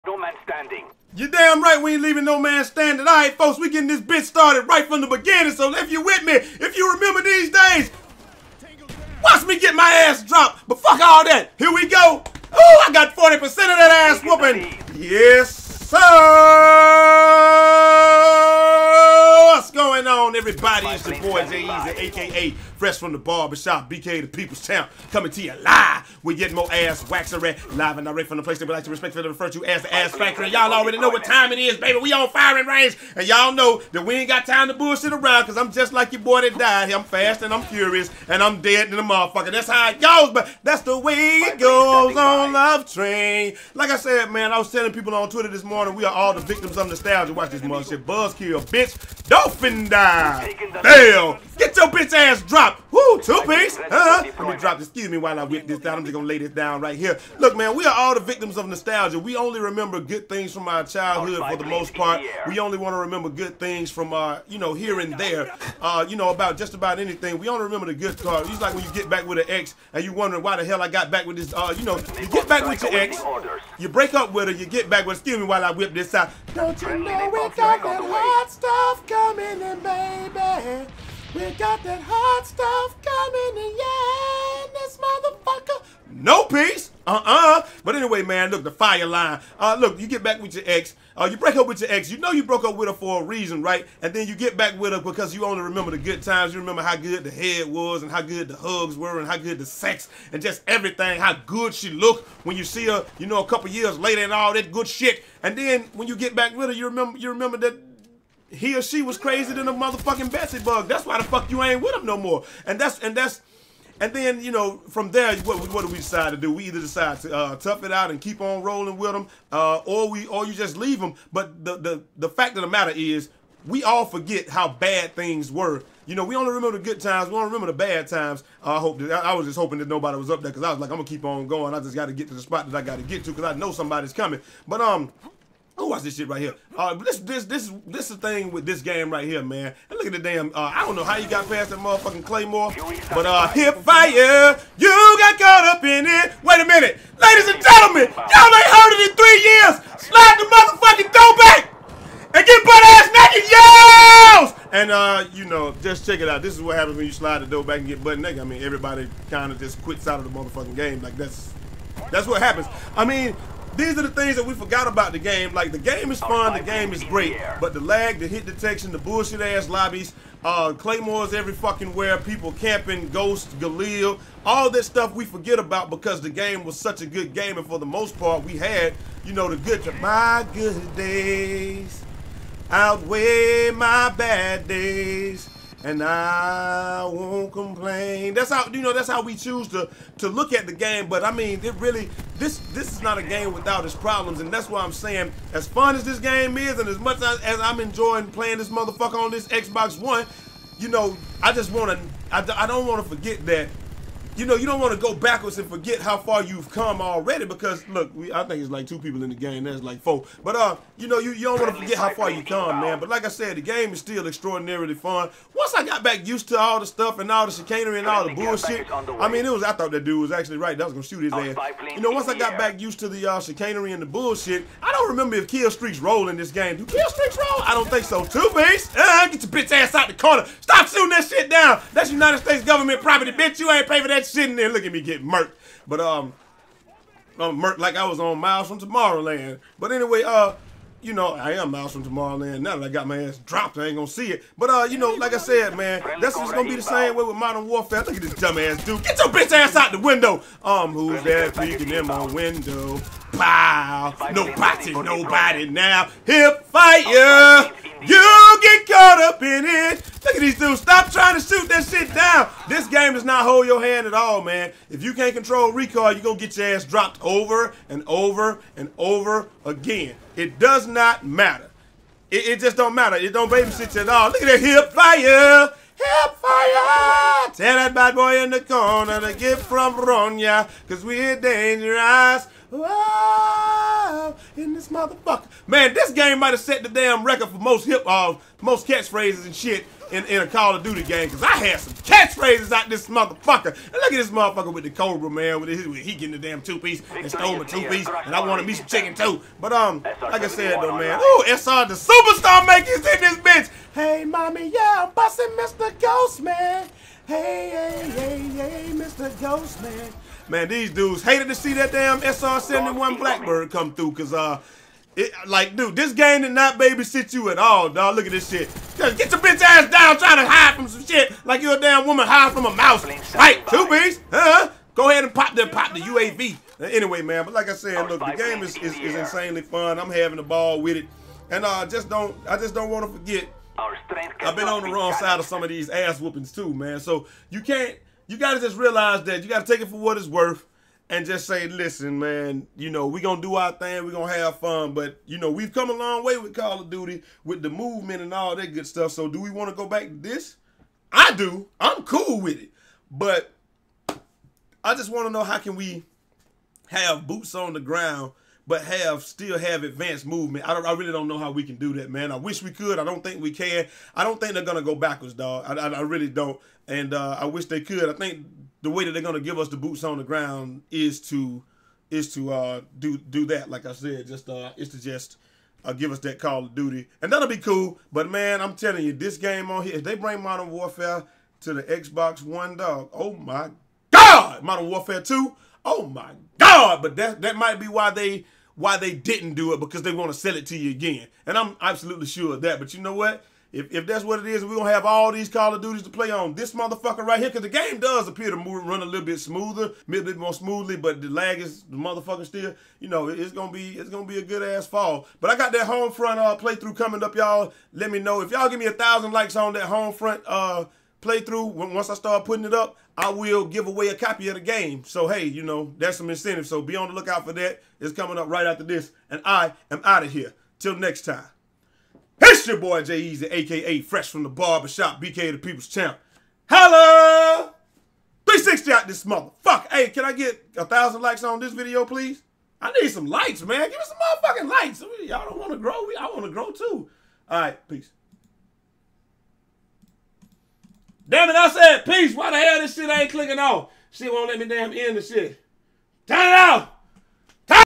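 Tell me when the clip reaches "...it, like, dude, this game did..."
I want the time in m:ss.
5:15.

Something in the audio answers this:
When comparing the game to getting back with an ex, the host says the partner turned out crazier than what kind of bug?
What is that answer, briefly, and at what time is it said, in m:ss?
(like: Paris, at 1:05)
Betsy bug, at 1:50.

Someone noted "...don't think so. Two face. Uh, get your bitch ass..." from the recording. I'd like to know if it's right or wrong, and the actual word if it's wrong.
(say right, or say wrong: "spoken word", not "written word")
right.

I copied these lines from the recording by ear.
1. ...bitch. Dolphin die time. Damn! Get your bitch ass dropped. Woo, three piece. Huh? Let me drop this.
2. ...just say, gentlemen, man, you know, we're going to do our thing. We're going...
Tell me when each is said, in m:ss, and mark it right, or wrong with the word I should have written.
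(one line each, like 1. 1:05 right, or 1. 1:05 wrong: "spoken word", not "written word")
1. 0:48 wrong: "two", not "three"
2. 5:41 wrong: "listen", not "gentlemen".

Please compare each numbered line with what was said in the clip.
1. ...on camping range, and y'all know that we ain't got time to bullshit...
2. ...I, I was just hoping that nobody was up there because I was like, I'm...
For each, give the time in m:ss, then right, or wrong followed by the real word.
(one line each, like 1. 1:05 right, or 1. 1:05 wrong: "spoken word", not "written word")
1. 0:32 wrong: "firing", not "camping"
2. 2:09 right.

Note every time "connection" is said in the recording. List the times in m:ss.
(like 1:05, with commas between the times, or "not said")
not said.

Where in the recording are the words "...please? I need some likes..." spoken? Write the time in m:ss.
7:12.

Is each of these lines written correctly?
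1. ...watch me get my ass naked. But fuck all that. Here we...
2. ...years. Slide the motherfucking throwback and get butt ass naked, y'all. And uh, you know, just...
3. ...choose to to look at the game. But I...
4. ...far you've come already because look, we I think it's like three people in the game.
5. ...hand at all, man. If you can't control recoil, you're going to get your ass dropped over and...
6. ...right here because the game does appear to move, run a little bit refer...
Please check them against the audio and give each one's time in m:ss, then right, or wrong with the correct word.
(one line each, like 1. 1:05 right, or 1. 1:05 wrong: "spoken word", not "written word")
1. 0:09 wrong: "dropped", not "naked"
2. 2:29 right
3. 3:09 right
4. 3:26 wrong: "two", not "three"
5. 4:23 right
6. 6:37 wrong: "smoother", not "refer".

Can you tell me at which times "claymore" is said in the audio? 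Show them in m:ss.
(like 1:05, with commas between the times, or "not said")
2:22, 2:50.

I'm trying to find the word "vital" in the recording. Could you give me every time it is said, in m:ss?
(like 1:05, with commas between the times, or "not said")
not said.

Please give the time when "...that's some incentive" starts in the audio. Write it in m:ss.
6:55.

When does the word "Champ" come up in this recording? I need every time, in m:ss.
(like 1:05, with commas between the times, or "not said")
0:24, 7:05.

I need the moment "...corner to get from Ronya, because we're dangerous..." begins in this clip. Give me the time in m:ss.
4:38.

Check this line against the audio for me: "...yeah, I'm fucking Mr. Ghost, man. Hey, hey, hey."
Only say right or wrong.
wrong.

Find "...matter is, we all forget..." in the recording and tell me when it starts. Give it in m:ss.
2:02.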